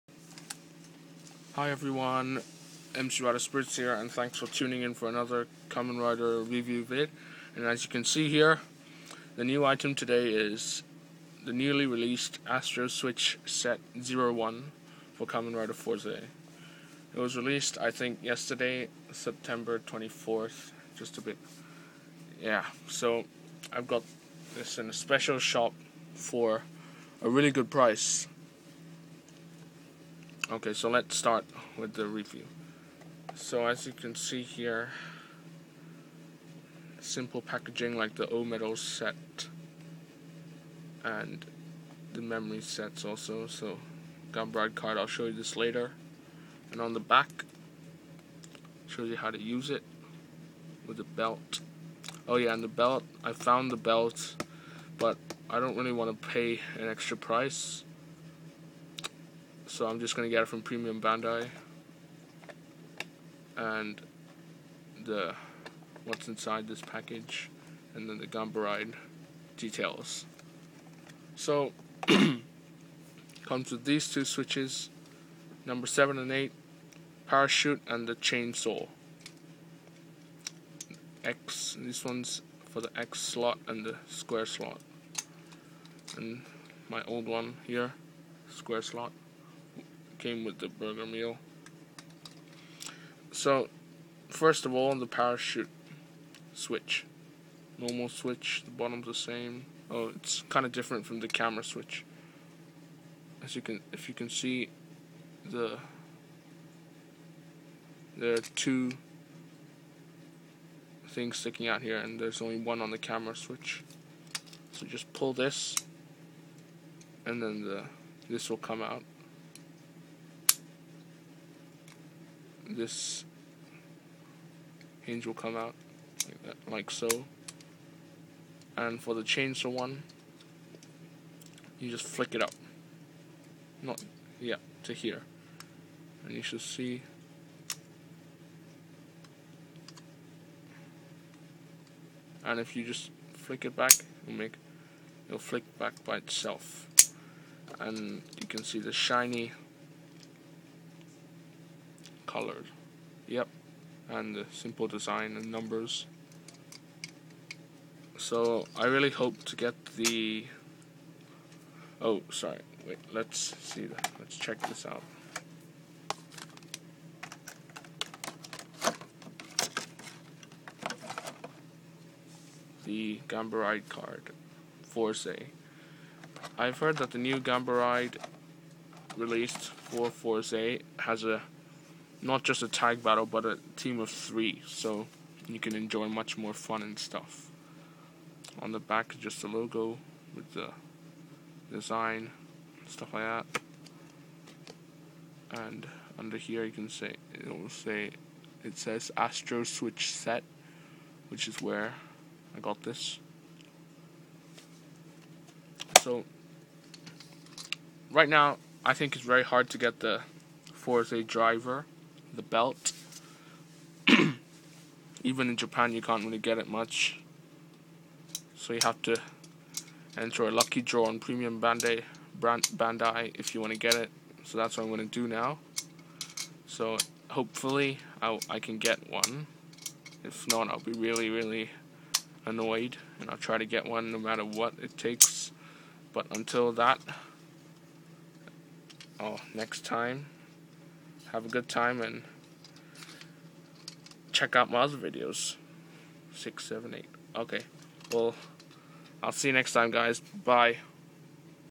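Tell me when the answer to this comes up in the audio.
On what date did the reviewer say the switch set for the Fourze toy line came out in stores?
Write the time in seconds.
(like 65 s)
19 s.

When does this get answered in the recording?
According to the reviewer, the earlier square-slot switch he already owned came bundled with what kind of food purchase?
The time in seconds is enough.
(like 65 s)
90 s.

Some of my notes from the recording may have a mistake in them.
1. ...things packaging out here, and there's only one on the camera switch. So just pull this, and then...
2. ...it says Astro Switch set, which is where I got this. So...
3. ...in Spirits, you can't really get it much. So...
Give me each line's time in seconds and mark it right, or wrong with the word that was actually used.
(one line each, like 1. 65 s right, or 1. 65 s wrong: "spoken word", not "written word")
1. 111 s wrong: "sticking", not "packaging"
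2. 198 s right
3. 215 s wrong: "Japan", not "Spirits".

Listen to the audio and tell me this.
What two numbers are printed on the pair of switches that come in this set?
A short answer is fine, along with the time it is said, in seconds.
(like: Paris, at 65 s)
7 and 8, at 75 s.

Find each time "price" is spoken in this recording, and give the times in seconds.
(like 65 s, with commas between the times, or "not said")
27 s, 57 s.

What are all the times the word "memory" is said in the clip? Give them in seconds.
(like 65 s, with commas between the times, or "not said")
42 s.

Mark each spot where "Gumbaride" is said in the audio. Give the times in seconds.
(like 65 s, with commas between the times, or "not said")
68 s.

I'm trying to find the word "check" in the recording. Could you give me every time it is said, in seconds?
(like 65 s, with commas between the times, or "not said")
164 s, 244 s.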